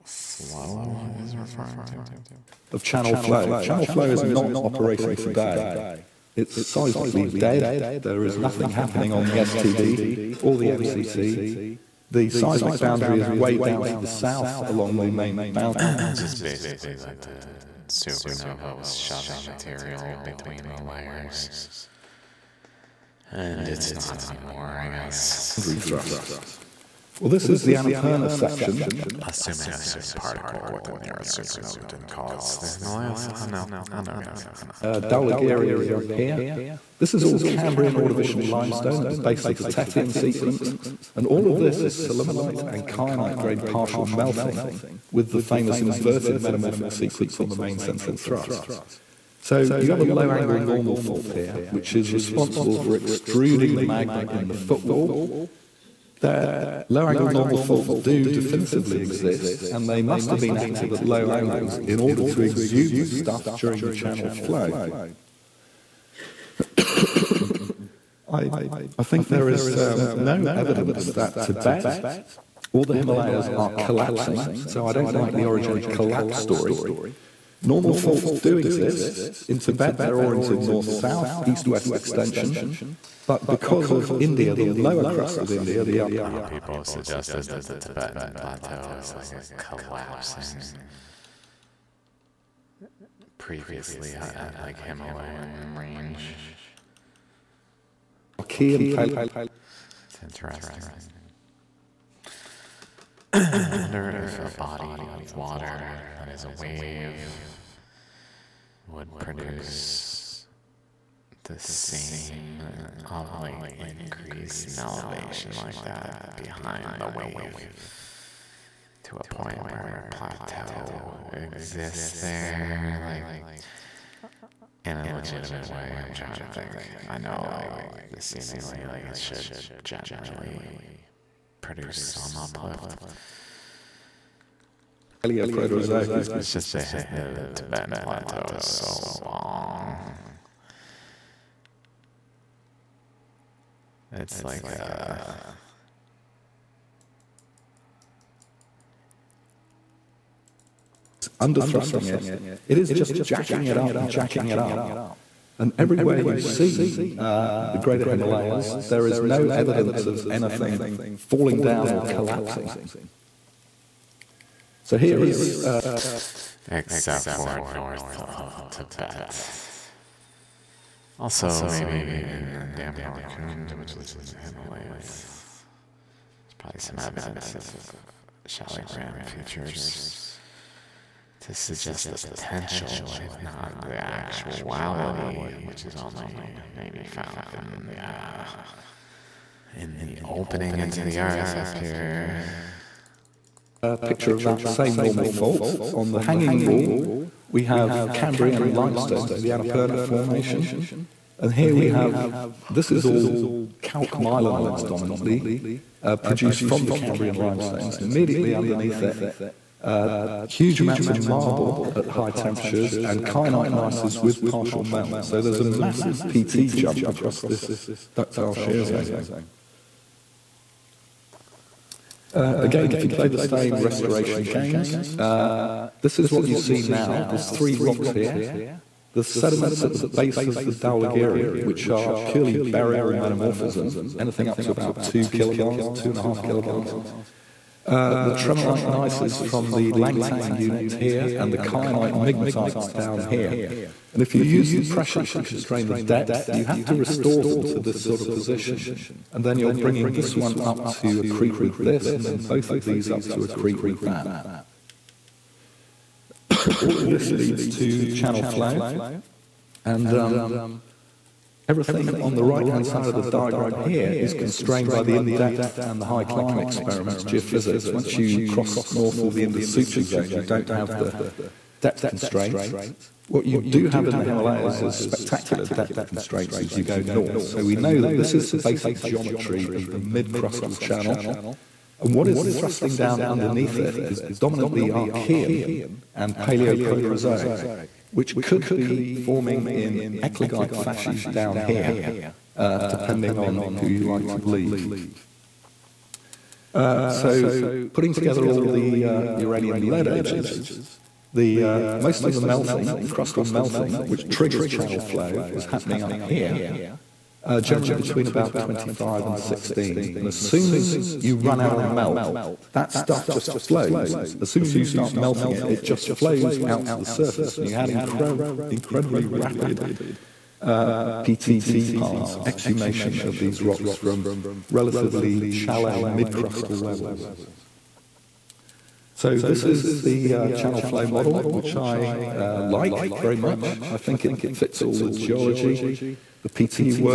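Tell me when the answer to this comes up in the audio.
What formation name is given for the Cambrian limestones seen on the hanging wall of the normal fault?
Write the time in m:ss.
3:19.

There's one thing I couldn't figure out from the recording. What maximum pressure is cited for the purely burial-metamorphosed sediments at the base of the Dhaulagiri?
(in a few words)
2.5 kilobars.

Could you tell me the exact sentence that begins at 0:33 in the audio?
I know, I know, guys, I know.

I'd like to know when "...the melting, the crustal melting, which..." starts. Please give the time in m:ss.
5:02.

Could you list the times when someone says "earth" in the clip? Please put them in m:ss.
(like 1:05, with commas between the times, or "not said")
0:31, 3:11.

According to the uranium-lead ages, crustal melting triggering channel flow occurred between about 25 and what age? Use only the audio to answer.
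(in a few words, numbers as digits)
16.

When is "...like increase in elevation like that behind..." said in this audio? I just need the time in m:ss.
1:53.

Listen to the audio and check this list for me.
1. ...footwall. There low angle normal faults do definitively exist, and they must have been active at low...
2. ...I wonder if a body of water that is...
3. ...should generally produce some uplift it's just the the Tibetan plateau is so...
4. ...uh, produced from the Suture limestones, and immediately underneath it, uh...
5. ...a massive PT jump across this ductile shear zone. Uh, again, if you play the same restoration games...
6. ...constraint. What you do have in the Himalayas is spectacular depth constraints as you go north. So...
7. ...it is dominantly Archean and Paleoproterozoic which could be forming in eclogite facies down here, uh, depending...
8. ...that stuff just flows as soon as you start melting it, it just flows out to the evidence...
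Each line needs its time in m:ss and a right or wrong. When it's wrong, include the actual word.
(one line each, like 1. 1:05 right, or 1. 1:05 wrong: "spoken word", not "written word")
1. 0:54 right
2. 1:43 right
3. 2:09 right
4. 3:26 wrong: "Cambrian", not "Suture"
5. 3:35 right
6. 4:32 right
7. 4:43 right
8. 5:12 wrong: "surface", not "evidence".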